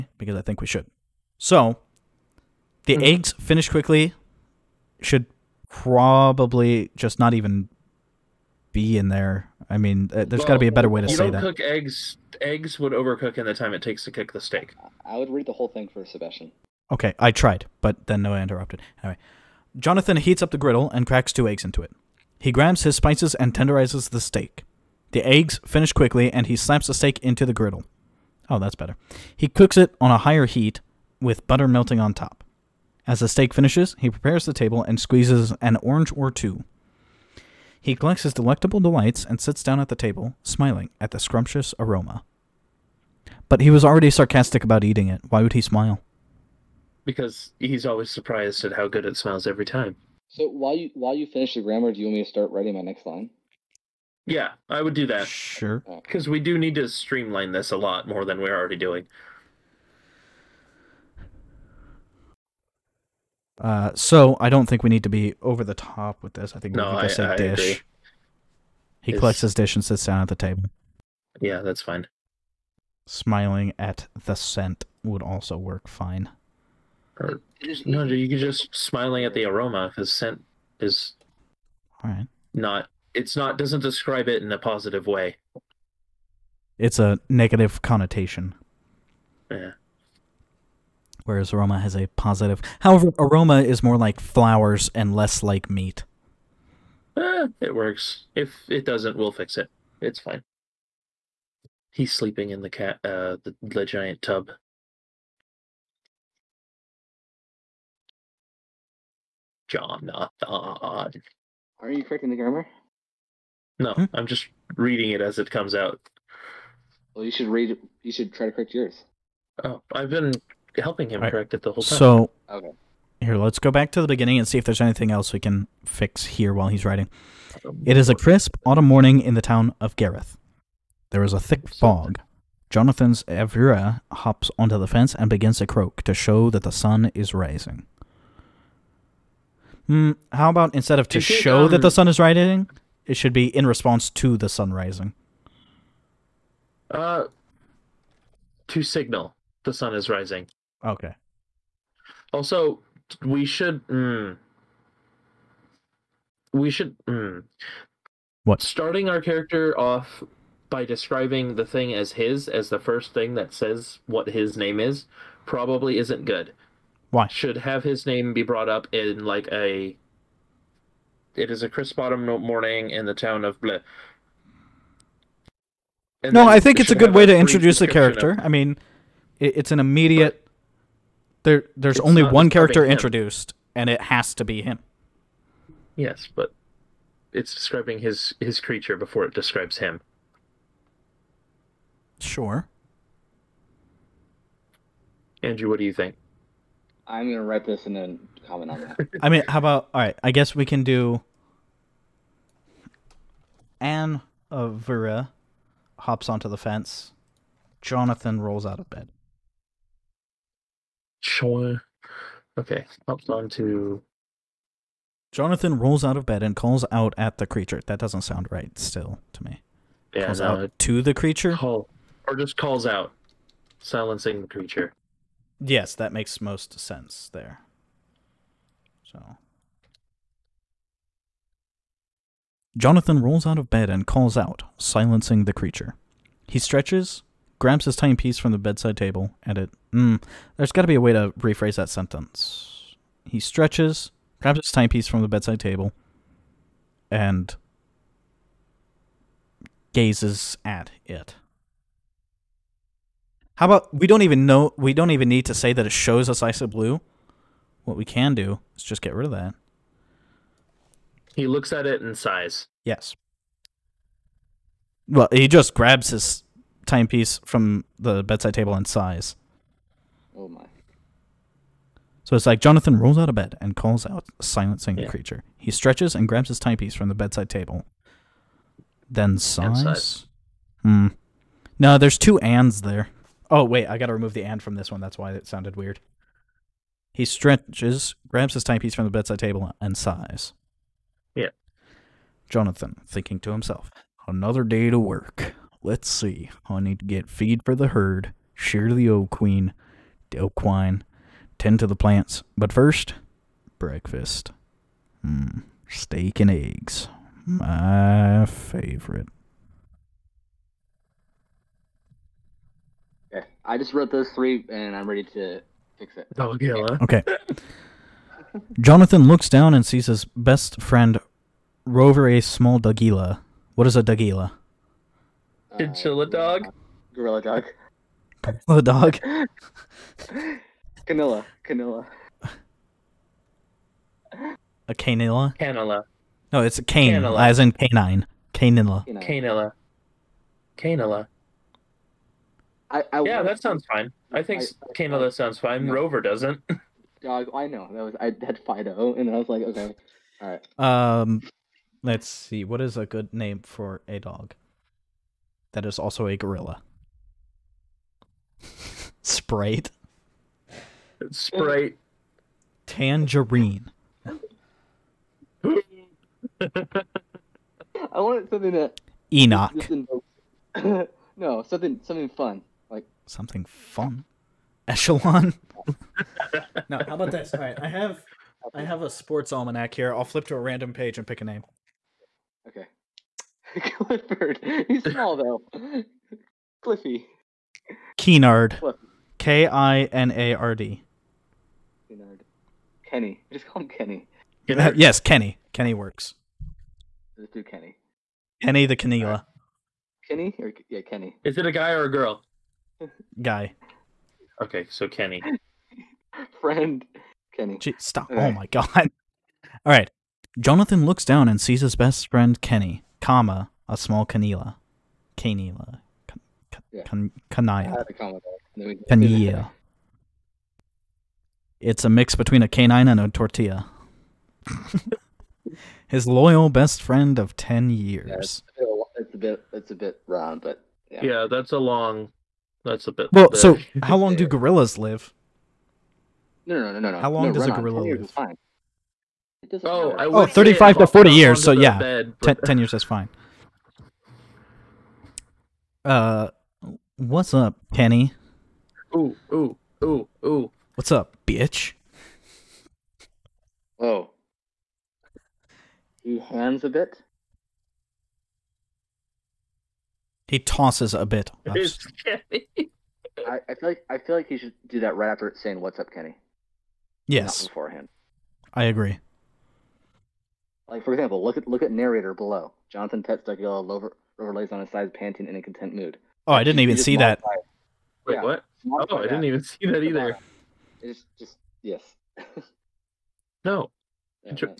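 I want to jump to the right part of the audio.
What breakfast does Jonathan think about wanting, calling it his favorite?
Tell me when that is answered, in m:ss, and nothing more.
5:05.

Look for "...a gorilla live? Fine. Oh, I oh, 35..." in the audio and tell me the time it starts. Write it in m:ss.
7:17.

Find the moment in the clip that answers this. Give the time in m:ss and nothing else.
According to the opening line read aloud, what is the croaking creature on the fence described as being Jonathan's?
2:13.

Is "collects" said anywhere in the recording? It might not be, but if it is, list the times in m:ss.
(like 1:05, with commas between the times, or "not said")
0:37, 1:09.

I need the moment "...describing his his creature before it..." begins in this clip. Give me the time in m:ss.
3:07.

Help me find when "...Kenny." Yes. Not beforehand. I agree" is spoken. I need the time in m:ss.
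7:46.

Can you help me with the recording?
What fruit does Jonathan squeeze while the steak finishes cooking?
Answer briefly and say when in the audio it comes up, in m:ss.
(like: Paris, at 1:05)
Orange, at 0:35.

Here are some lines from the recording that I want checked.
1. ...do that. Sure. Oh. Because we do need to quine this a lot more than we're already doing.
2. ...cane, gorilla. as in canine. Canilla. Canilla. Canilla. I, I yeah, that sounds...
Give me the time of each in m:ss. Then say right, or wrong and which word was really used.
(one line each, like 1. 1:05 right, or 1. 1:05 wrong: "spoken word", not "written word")
1. 0:54 wrong: "streamline", not "quine"
2. 5:36 wrong: "canilla", not "gorilla".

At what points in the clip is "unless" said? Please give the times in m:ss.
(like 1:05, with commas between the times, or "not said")
not said.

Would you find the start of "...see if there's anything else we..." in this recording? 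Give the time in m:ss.
2:04.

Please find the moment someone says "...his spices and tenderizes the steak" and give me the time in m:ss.
0:22.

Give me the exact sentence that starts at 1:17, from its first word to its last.
Or, uh, no, you could just smiling at the aroma because scent is all right.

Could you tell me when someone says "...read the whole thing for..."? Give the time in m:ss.
0:15.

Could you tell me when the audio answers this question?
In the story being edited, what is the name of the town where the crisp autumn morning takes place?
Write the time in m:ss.
2:09.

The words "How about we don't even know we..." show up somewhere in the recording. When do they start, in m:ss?
4:13.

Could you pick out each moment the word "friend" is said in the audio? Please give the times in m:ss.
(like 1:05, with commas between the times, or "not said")
5:20, 6:46, 6:52, 7:07.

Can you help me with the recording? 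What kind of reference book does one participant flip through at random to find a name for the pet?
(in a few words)
Sports almanac.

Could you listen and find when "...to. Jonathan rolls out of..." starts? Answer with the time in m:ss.
3:33.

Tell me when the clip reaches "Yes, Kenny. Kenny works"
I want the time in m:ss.
6:34.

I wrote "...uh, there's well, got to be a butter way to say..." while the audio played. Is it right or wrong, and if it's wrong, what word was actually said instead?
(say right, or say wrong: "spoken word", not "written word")
wrong: "better", not "butter".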